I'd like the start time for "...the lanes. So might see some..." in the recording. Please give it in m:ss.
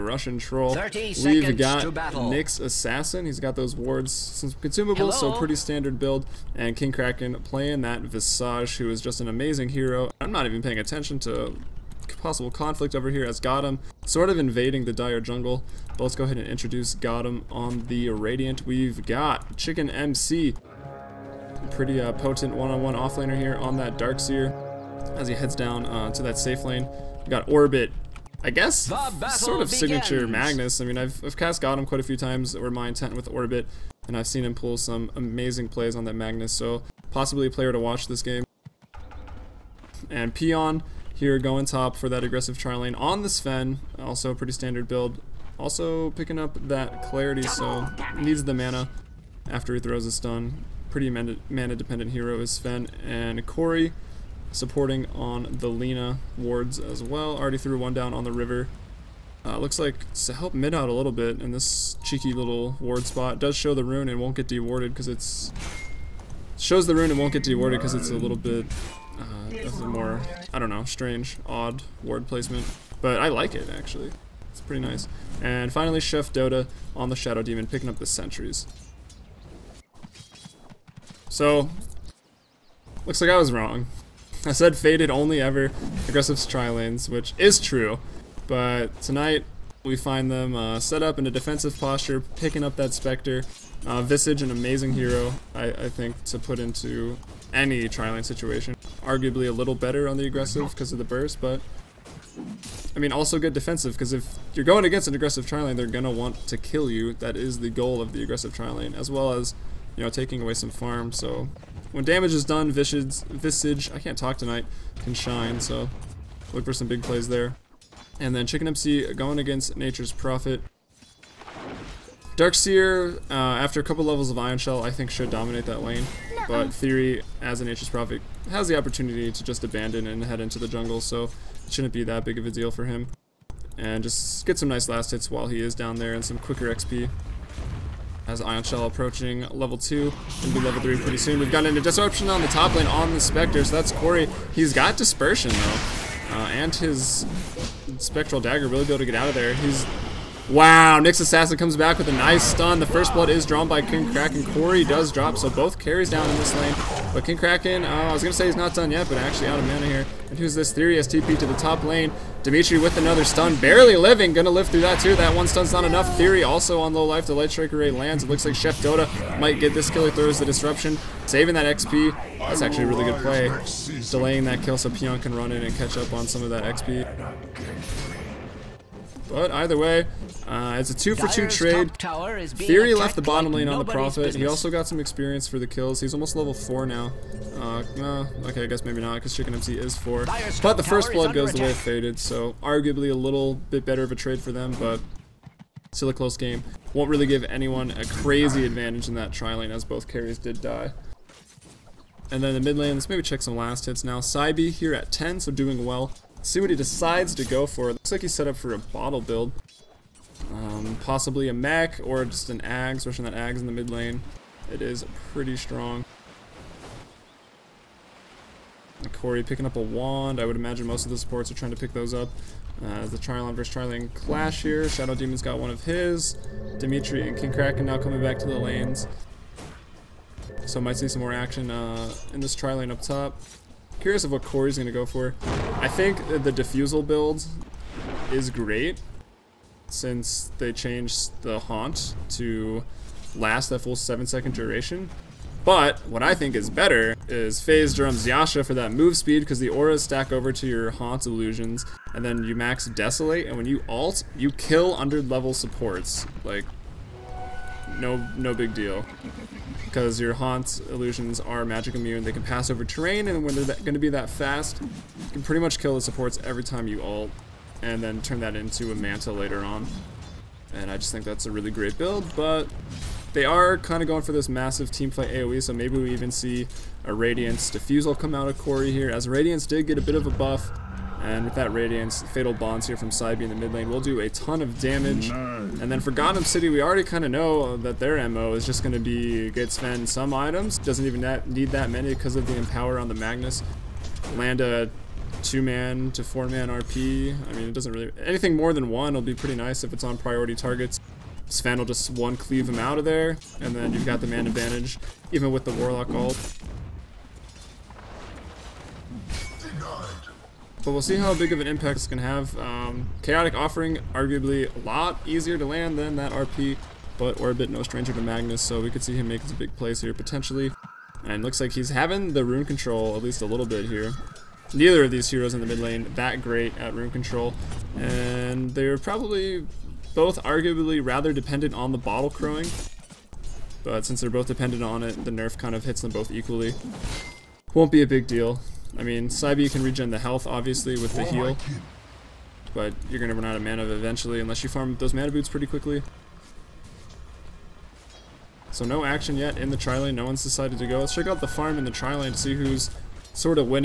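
3:48.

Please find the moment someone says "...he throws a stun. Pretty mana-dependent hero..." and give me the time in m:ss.
0:49.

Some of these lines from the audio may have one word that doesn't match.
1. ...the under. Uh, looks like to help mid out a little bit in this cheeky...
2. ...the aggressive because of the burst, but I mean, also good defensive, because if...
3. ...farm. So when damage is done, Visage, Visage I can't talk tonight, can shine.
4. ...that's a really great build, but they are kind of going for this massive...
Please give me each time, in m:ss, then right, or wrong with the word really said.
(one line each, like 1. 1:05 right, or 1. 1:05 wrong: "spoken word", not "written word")
1. 0:58 wrong: "river", not "under"
2. 1:40 right
3. 1:50 right
4. 4:31 right.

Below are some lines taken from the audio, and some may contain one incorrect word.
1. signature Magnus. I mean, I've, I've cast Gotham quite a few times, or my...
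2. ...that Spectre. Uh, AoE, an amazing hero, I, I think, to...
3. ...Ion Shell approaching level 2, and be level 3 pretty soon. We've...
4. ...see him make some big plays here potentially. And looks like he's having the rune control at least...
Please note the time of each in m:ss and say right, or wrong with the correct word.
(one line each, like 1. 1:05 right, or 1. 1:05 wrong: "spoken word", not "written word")
1. 0:29 right
2. 1:32 wrong: "Visage", not "AoE"
3. 2:18 right
4. 5:19 right.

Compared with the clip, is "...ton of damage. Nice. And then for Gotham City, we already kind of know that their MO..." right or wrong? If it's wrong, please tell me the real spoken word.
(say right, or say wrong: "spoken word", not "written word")
right.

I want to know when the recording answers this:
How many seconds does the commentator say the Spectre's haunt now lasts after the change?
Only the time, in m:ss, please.
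4:03.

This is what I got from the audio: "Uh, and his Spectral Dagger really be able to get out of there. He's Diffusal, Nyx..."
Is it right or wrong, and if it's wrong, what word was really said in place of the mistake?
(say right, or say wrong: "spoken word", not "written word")
wrong: "Wow", not "Diffusal".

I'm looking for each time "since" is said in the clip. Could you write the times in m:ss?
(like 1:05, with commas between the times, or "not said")
0:04, 3:59, 5:34.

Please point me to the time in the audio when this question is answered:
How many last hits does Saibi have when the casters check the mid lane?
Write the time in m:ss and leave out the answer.
3:25.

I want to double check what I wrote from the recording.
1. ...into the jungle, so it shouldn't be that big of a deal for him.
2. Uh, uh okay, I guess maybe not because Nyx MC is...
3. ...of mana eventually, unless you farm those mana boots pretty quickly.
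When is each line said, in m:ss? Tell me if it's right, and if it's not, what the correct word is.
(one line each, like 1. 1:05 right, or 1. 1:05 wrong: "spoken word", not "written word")
1. 2:10 right
2. 3:07 wrong: "Chicken", not "Nyx"
3. 5:43 right.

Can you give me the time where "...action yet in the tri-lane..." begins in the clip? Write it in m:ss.
5:49.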